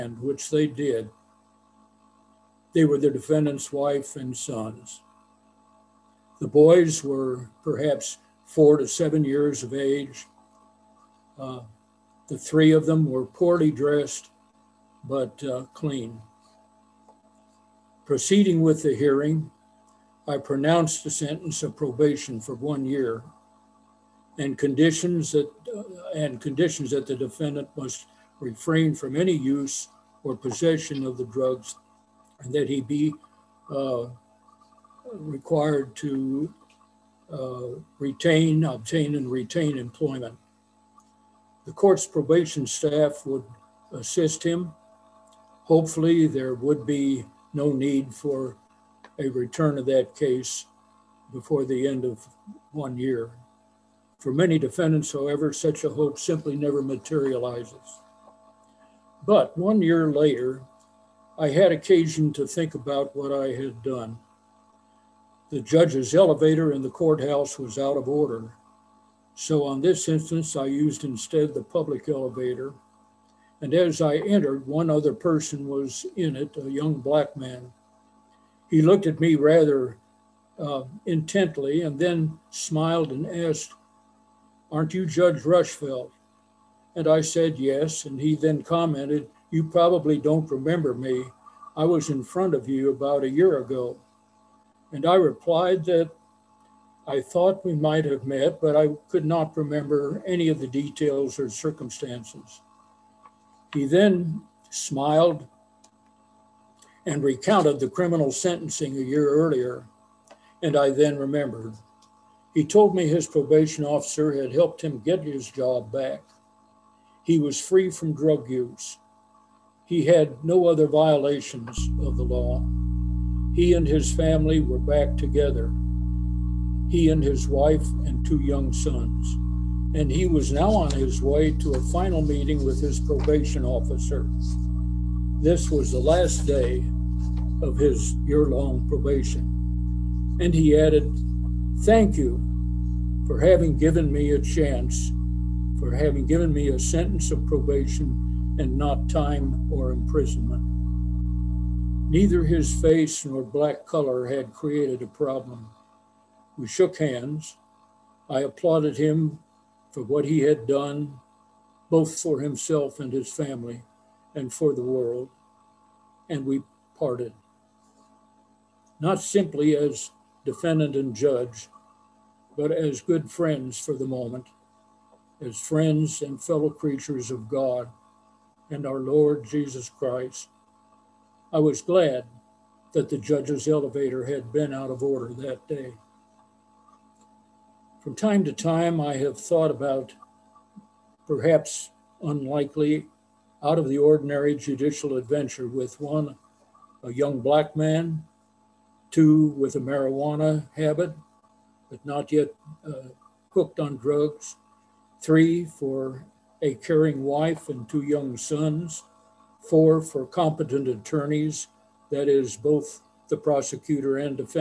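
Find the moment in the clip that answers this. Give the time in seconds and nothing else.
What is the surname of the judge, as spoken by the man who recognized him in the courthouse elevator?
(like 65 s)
85 s.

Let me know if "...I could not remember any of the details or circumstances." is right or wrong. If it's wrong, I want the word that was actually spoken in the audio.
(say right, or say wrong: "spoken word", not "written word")
right.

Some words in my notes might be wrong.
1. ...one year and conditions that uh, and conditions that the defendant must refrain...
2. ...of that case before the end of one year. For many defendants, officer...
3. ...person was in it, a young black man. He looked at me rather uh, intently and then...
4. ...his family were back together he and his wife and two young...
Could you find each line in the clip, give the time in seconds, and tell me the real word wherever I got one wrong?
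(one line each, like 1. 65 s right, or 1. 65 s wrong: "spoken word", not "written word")
1. 22 s right
2. 49 s wrong: "however", not "officer"
3. 75 s right
4. 123 s right.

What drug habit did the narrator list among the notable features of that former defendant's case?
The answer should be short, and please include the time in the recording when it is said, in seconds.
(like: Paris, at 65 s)
Marijuana, at 199 s.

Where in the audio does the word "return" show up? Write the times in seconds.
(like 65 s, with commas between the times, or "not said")
49 s.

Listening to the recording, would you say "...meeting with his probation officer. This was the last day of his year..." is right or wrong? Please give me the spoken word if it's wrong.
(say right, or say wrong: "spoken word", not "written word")
right.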